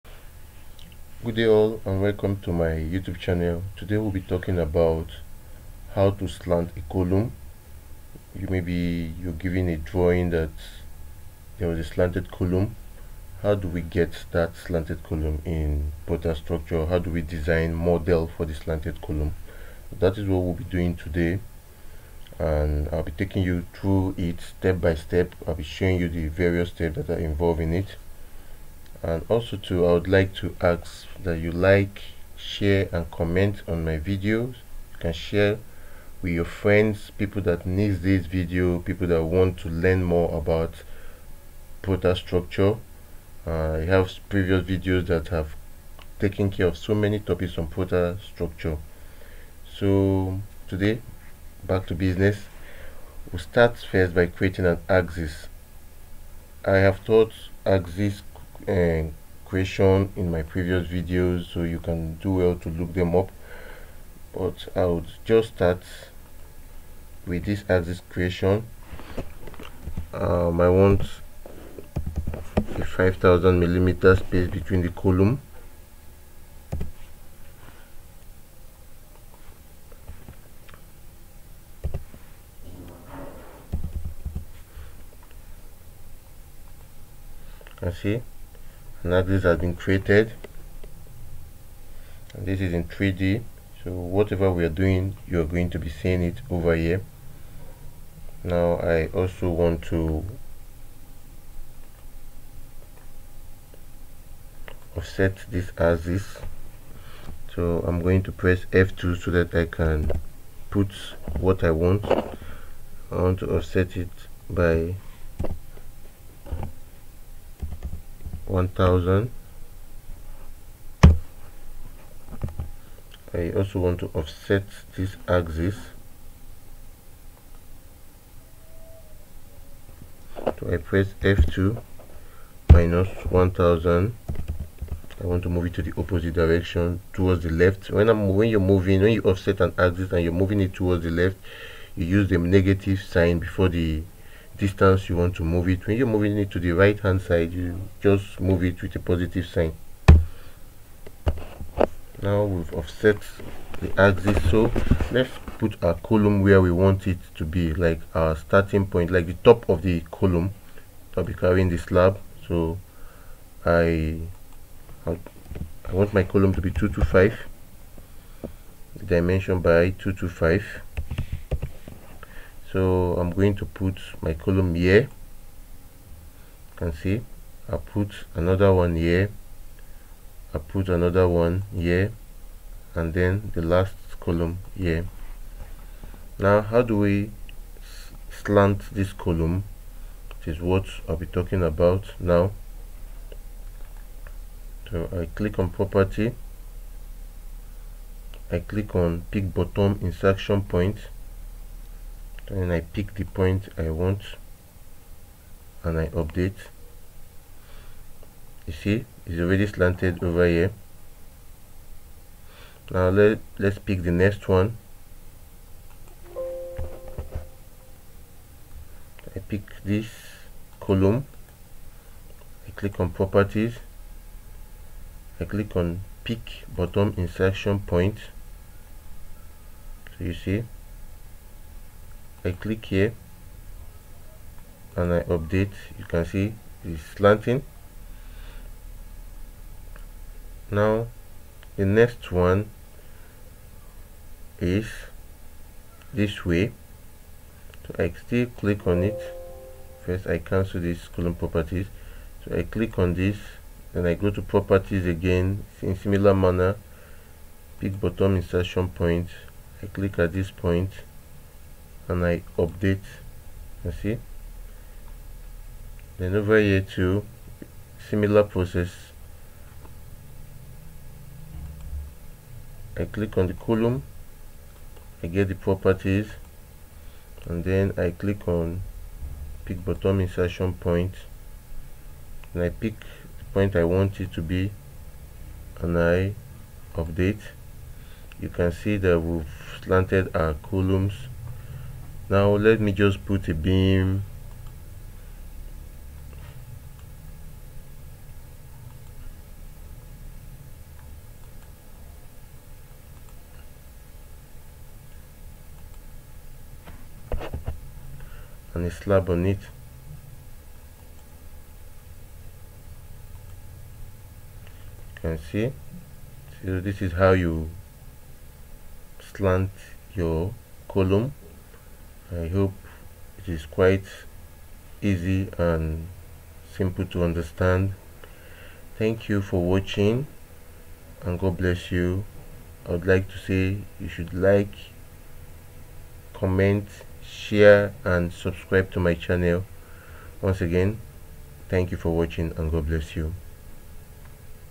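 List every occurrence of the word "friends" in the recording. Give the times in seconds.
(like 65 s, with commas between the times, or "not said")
36 s.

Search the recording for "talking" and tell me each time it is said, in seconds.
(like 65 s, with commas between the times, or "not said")
4 s, 191 s.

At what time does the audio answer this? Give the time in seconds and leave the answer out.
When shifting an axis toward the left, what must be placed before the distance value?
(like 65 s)
142 s.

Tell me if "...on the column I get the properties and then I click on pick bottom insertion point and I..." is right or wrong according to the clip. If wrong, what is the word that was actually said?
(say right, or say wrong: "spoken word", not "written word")
right.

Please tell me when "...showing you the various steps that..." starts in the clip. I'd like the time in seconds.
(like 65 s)
25 s.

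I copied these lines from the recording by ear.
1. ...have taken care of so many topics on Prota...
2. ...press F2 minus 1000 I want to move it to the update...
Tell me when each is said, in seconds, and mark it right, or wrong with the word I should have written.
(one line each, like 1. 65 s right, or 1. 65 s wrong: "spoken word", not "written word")
1. 45 s right
2. 130 s wrong: "opposite", not "update".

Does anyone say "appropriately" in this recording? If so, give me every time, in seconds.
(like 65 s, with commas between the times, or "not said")
not said.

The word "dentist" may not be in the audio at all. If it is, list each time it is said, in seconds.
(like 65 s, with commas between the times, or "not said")
not said.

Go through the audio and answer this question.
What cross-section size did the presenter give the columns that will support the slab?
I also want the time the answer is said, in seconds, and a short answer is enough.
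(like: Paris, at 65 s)
225 by 225, at 166 s.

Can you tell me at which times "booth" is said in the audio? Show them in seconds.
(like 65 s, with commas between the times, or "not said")
not said.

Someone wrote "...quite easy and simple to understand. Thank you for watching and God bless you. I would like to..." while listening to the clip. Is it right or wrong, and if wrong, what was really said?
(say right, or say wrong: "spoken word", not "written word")
right.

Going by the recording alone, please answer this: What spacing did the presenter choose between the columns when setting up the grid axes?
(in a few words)
5000 millimeters.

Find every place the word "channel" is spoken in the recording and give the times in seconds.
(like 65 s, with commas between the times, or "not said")
3 s, 339 s.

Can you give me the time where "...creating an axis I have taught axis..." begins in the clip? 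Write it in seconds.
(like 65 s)
54 s.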